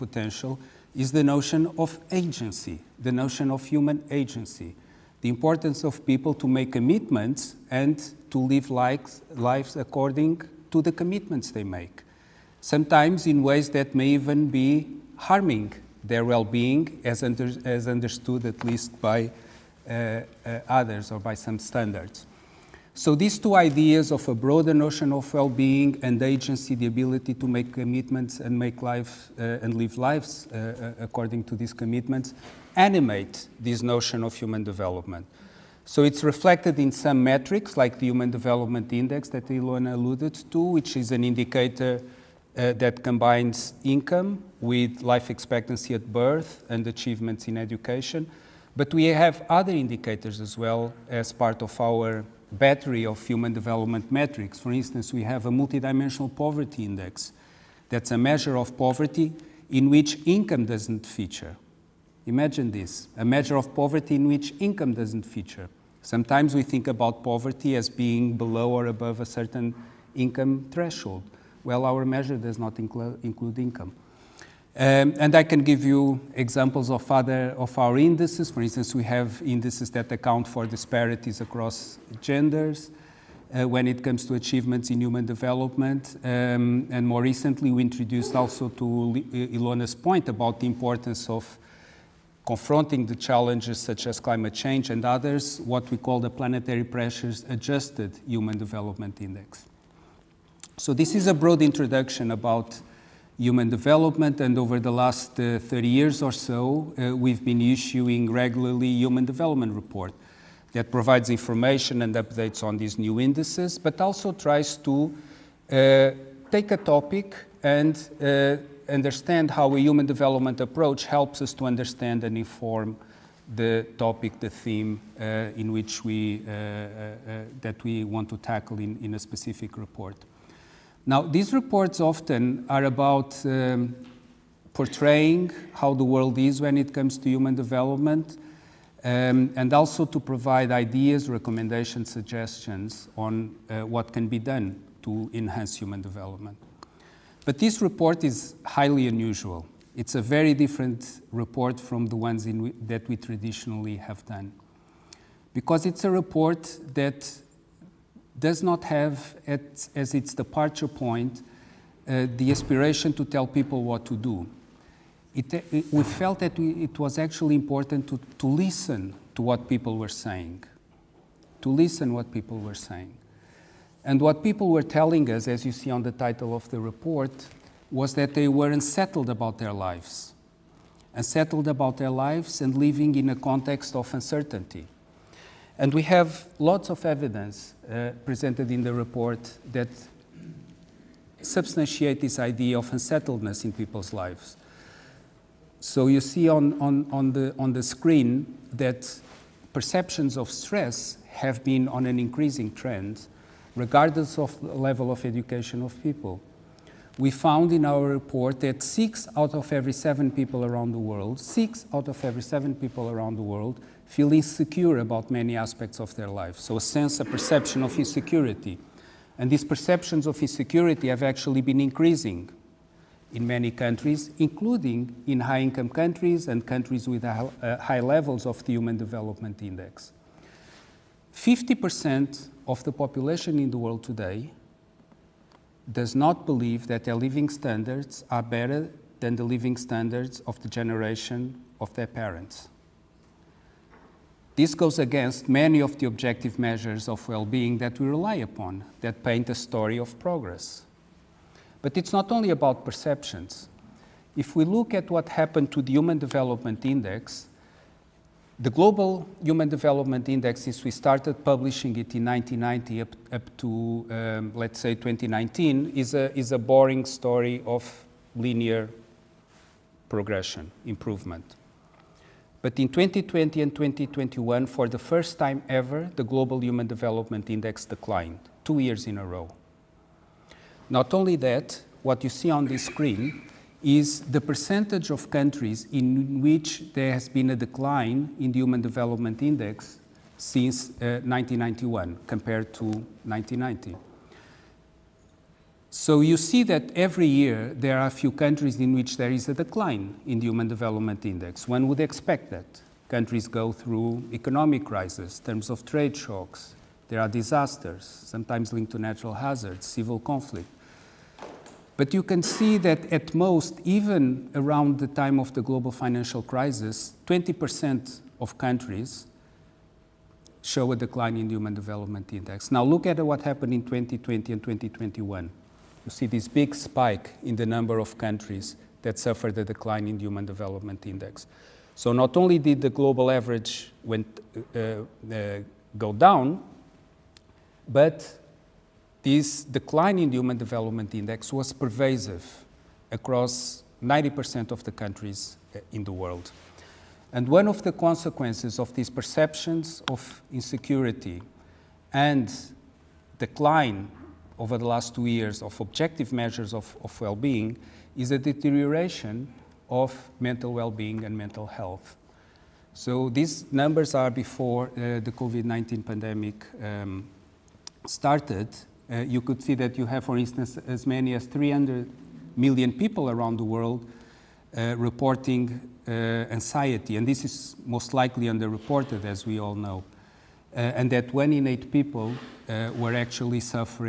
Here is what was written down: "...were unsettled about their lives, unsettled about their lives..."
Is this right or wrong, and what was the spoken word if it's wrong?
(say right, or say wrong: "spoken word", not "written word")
right.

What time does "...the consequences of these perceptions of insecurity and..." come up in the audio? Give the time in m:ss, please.
5:47.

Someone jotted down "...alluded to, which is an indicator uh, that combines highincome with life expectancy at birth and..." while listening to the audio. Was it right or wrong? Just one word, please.
wrong.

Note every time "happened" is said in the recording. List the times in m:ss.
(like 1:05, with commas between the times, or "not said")
4:15, 5:23.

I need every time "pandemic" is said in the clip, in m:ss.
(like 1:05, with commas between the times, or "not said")
6:06.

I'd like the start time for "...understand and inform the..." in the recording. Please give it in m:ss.
2:01.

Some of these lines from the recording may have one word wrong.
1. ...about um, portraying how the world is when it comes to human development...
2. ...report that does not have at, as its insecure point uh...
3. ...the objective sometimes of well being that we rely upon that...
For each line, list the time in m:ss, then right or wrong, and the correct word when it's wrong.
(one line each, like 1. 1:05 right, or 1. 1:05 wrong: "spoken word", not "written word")
1. 2:12 right
2. 2:36 wrong: "departure", not "insecure"
3. 4:05 wrong: "measures", not "sometimes".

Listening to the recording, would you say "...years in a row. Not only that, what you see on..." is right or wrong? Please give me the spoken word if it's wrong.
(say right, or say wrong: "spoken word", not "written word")
right.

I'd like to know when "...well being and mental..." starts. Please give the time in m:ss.
6:00.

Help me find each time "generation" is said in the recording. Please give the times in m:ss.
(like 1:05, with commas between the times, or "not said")
4:00.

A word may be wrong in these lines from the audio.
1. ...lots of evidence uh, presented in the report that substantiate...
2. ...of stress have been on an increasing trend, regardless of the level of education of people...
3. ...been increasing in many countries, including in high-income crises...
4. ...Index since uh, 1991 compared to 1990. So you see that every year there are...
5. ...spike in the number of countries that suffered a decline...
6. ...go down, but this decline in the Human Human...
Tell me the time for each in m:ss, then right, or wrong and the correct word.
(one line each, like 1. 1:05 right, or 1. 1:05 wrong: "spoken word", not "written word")
1. 3:06 right
2. 3:20 right
3. 3:41 wrong: "countries", not "crises"
4. 4:49 right
5. 5:26 right
6. 5:35 wrong: "Development", not "Human".